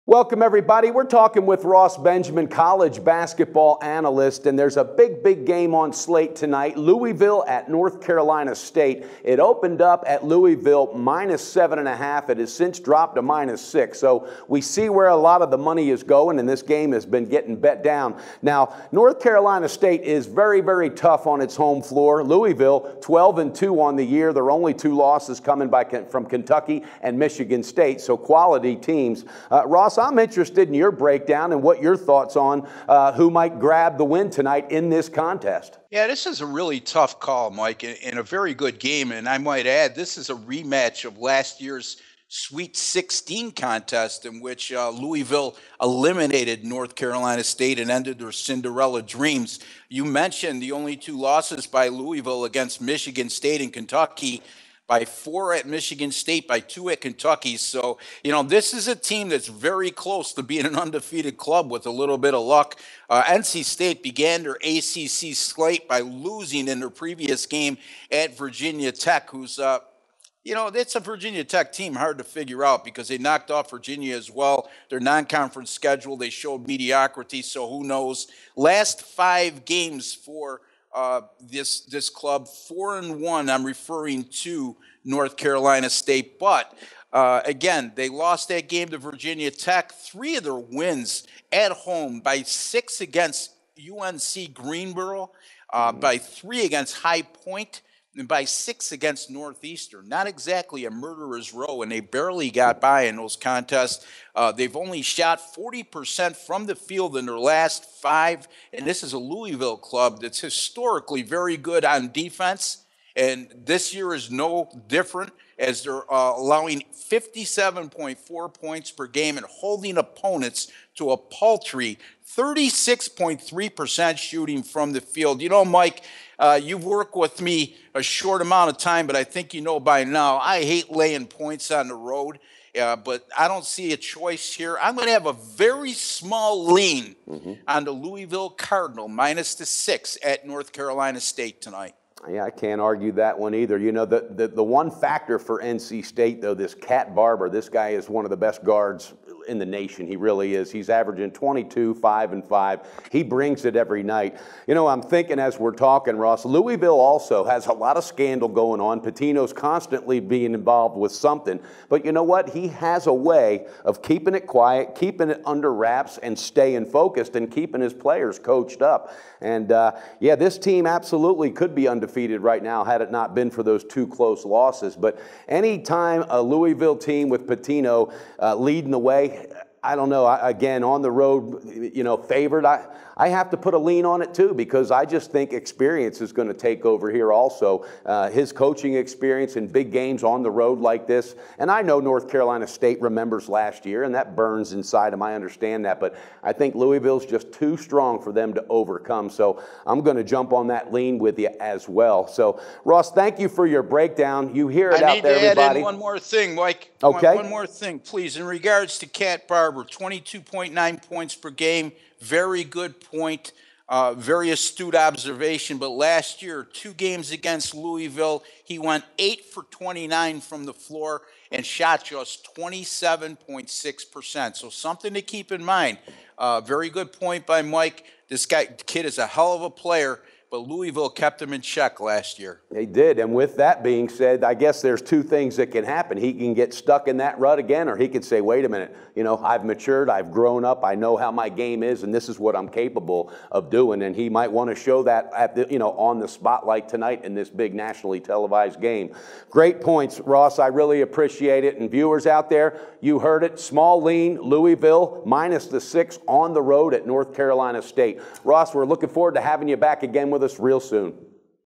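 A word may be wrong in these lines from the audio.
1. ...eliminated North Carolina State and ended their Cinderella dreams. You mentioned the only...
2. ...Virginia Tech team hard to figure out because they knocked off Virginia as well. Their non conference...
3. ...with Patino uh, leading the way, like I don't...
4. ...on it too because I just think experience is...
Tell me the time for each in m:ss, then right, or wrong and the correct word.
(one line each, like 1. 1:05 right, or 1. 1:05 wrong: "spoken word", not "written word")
1. 0:45 right
2. 1:10 right
3. 2:57 right
4. 3:04 right.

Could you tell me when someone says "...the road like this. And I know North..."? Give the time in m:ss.
3:10.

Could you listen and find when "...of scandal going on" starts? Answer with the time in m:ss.
2:37.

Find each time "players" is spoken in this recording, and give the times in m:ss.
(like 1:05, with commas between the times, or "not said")
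2:47, 3:49.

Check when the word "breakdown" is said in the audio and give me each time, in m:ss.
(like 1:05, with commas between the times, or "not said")
0:30, 3:23.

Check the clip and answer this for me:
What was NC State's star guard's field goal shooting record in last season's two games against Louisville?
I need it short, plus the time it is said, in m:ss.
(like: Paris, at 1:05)
8 for 29, at 3:39.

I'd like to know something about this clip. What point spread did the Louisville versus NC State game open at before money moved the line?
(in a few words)
Louisville -7.5.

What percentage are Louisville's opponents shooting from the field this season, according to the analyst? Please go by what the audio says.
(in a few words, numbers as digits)
36.3%.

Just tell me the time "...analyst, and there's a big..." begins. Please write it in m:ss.
0:03.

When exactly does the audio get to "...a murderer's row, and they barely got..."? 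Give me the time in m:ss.
1:40.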